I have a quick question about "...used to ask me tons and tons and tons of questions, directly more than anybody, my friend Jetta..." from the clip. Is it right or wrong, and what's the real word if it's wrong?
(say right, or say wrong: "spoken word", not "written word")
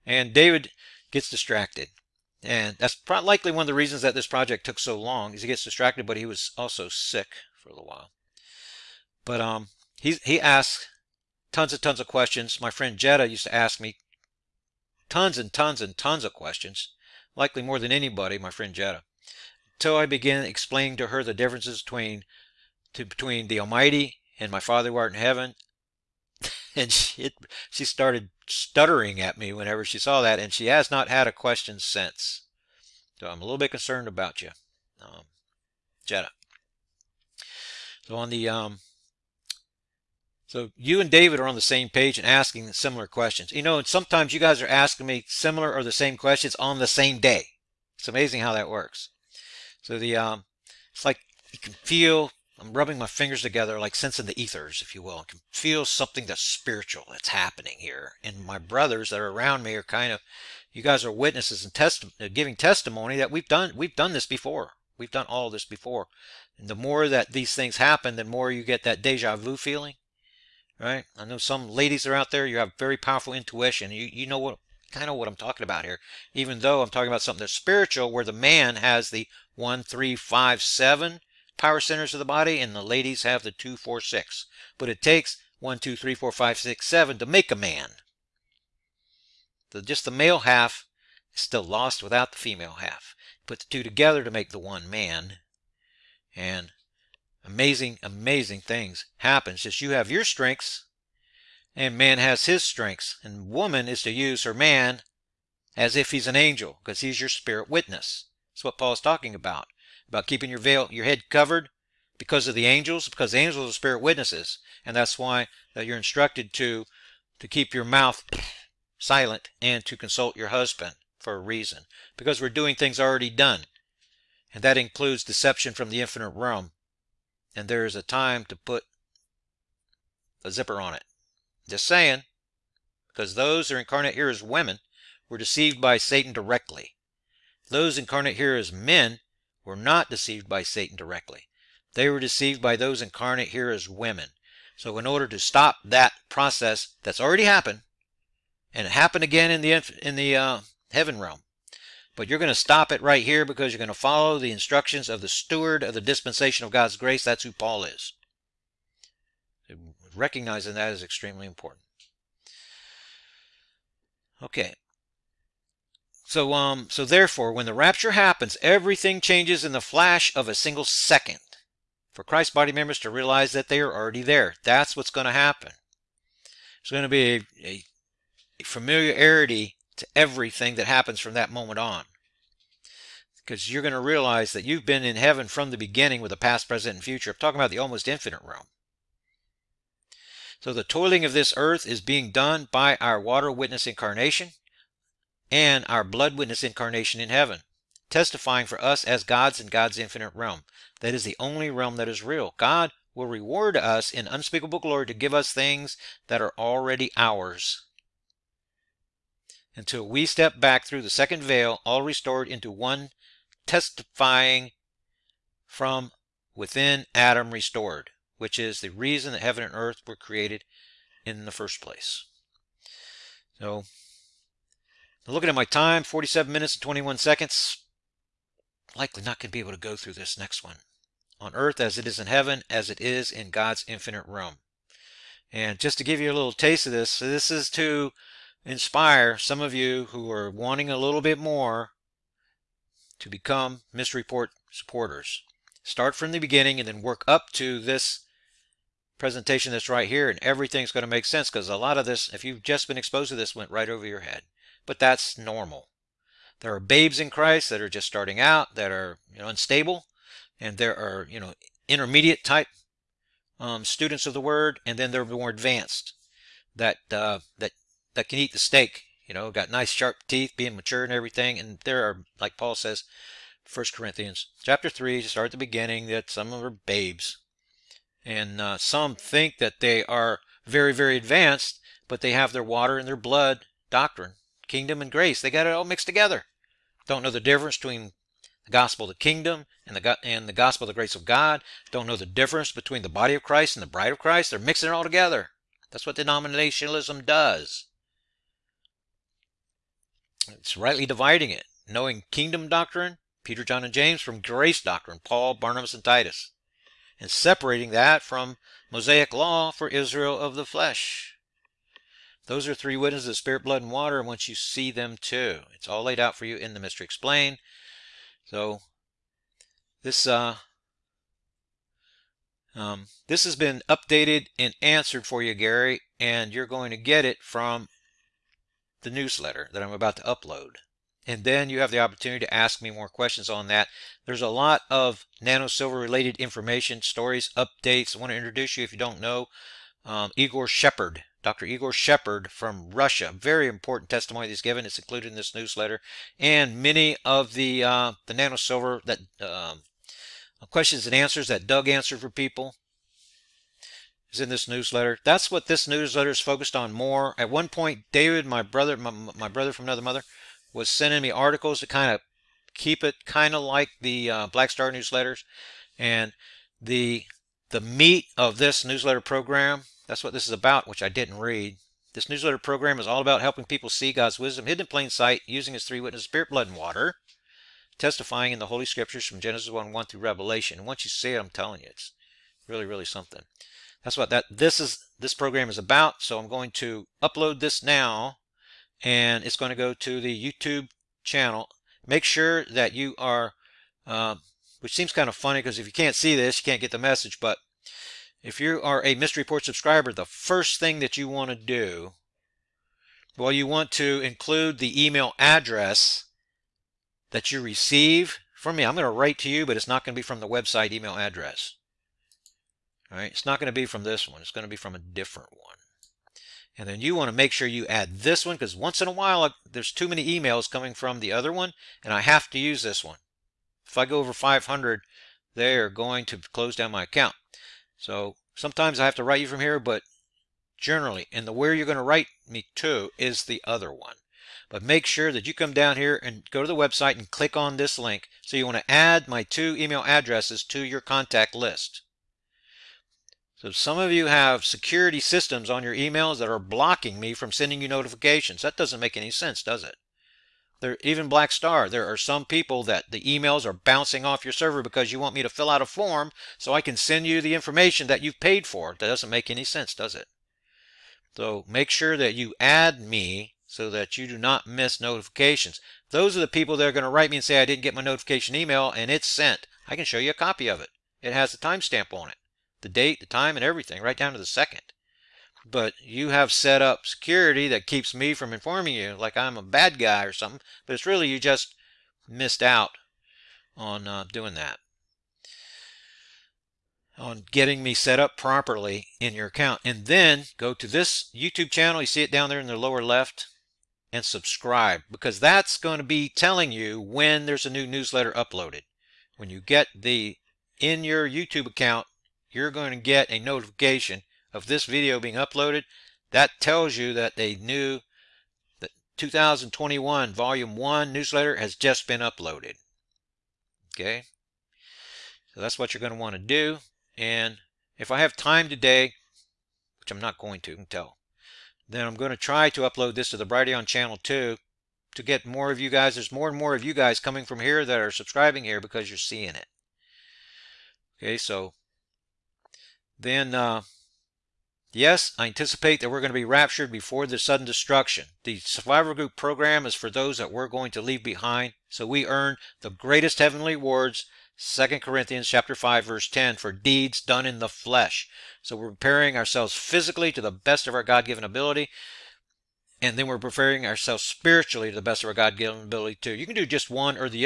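wrong: "likely", not "directly".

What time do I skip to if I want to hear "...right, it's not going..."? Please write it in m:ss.
6:53.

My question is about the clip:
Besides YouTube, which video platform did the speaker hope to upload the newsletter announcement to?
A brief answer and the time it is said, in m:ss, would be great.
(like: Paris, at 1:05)
Brighteon, at 8:43.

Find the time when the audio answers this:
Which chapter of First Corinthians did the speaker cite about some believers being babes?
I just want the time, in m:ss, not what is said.
4:33.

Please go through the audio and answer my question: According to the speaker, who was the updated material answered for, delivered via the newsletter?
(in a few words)
Gary.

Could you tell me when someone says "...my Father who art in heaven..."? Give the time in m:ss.
0:24.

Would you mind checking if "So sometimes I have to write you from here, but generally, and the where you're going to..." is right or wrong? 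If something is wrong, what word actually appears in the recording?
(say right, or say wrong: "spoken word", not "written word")
right.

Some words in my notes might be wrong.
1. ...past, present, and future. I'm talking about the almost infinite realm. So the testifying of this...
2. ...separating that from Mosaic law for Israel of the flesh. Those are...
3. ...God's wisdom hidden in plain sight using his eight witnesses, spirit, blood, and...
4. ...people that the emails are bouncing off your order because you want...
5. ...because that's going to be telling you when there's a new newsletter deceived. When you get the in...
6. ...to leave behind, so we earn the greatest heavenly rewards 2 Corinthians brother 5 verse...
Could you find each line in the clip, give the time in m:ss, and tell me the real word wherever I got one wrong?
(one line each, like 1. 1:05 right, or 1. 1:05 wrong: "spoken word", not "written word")
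1. 3:06 wrong: "toiling", not "testifying"
2. 5:07 right
3. 6:14 wrong: "three", not "eight"
4. 7:32 wrong: "server", not "order"
5. 8:15 wrong: "uploaded", not "deceived"
6. 9:00 wrong: "chapter", not "brother".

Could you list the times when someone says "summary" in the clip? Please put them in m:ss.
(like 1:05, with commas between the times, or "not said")
not said.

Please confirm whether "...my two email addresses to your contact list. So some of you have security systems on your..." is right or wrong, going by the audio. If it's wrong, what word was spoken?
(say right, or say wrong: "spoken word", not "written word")
right.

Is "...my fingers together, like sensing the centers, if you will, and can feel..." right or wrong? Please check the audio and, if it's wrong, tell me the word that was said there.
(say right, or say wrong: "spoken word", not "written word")
wrong: "ethers", not "centers".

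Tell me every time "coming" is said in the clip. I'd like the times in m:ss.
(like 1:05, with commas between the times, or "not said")
7:00, 8:47.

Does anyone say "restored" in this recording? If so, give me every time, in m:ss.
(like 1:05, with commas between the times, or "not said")
3:32, 3:37.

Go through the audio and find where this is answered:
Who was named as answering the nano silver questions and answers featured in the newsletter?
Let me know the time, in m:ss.
5:51.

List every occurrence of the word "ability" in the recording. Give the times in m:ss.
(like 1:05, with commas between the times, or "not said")
9:11, 9:15.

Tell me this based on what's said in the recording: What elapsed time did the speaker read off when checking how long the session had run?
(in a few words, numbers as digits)
47 minutes and 21 seconds.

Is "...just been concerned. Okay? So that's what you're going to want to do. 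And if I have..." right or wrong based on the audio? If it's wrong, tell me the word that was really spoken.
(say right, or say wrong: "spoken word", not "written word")
wrong: "uploaded", not "concerned".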